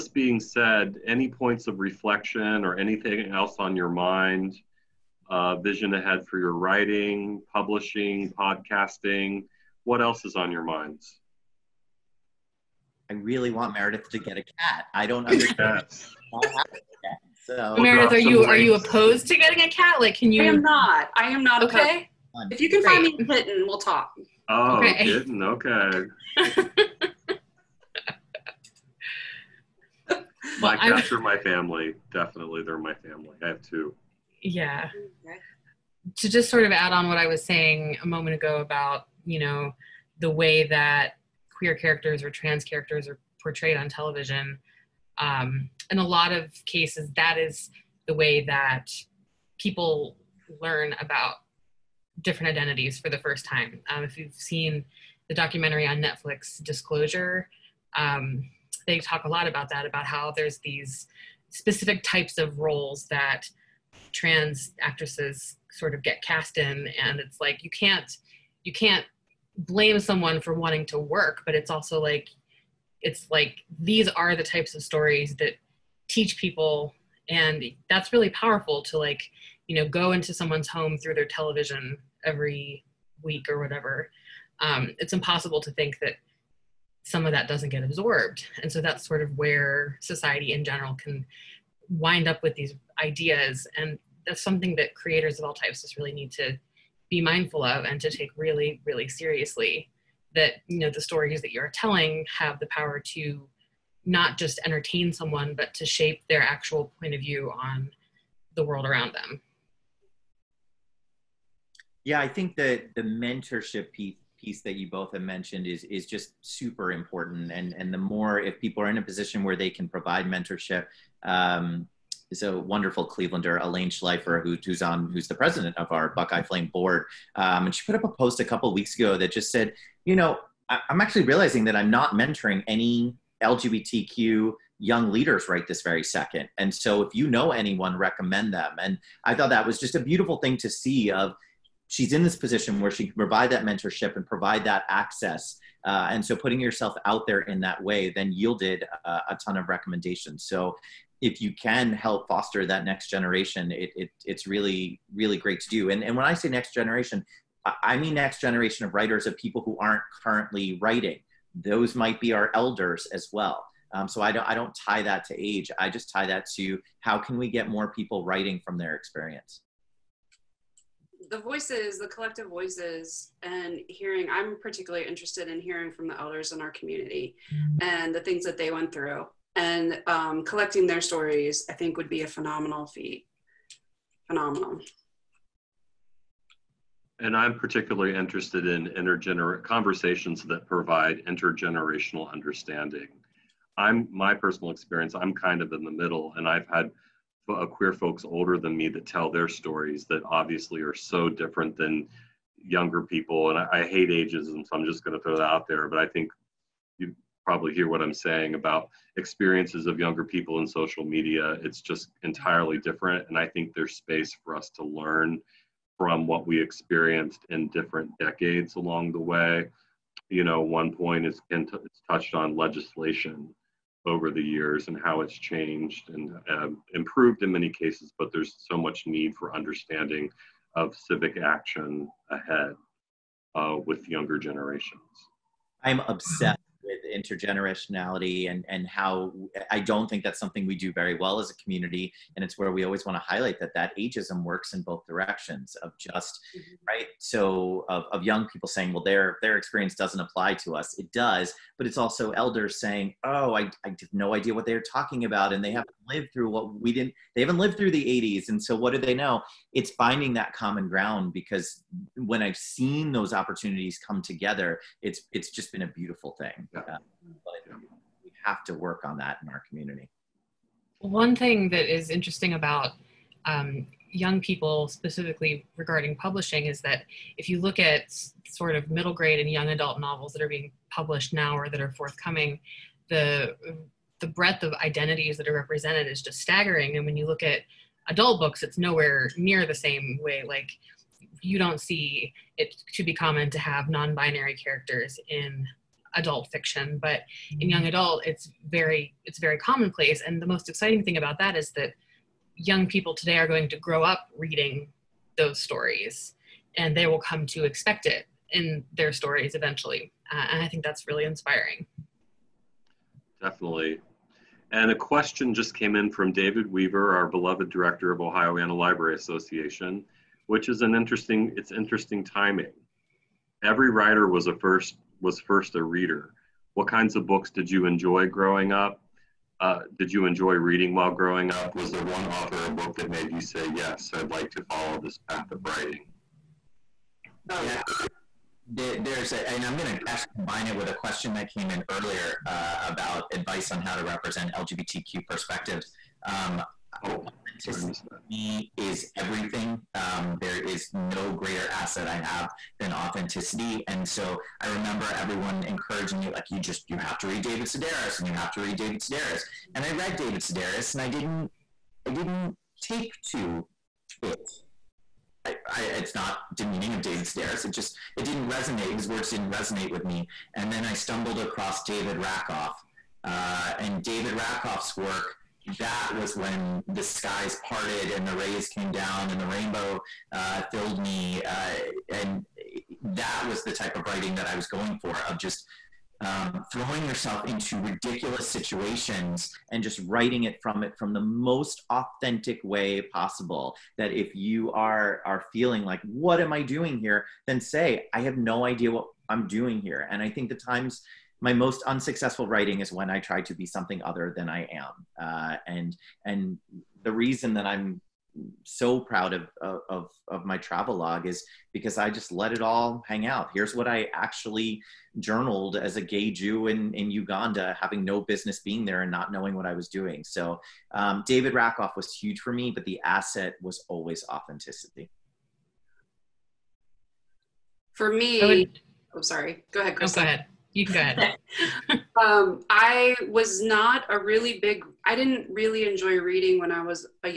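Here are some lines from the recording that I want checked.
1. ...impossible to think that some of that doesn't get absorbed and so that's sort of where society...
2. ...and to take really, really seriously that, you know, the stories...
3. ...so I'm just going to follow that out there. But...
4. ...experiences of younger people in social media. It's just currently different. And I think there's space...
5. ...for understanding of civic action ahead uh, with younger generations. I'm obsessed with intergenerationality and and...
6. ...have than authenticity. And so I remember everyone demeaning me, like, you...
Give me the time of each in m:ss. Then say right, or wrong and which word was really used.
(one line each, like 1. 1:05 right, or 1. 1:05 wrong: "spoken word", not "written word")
1. 1:25 right
2. 1:37 right
3. 3:24 wrong: "throw", not "follow"
4. 3:29 wrong: "entirely", not "currently"
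5. 3:49 right
6. 5:52 wrong: "encouraging", not "demeaning".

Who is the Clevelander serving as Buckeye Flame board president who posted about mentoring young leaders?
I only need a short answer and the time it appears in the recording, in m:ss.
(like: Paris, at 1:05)
Elaine Schleifer, at 2:03.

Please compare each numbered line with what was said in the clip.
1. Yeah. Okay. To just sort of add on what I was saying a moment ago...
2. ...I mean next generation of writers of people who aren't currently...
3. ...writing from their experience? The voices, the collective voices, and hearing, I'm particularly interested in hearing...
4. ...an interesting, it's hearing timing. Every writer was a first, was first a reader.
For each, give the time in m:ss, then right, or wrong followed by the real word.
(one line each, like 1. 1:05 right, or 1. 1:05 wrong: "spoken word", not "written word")
1. 0:34 right
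2. 2:37 right
3. 2:48 right
4. 5:20 wrong: "interesting", not "hearing".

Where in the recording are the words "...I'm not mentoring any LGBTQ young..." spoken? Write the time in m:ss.
2:11.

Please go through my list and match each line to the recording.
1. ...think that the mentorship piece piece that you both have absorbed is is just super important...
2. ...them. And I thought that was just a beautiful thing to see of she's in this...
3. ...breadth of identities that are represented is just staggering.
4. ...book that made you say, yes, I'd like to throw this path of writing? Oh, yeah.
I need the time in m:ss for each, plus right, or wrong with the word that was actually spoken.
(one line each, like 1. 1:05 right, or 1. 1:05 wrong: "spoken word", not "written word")
1. 1:52 wrong: "mentioned", not "absorbed"
2. 2:18 right
3. 4:44 right
4. 5:32 wrong: "follow", not "throw".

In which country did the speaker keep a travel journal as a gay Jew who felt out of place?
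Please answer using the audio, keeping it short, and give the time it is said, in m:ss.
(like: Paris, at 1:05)
Uganda, at 6:57.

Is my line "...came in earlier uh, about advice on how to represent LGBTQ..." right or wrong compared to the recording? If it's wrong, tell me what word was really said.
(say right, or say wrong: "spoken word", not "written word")
right.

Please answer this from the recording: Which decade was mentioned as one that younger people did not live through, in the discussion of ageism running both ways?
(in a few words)
the 80s.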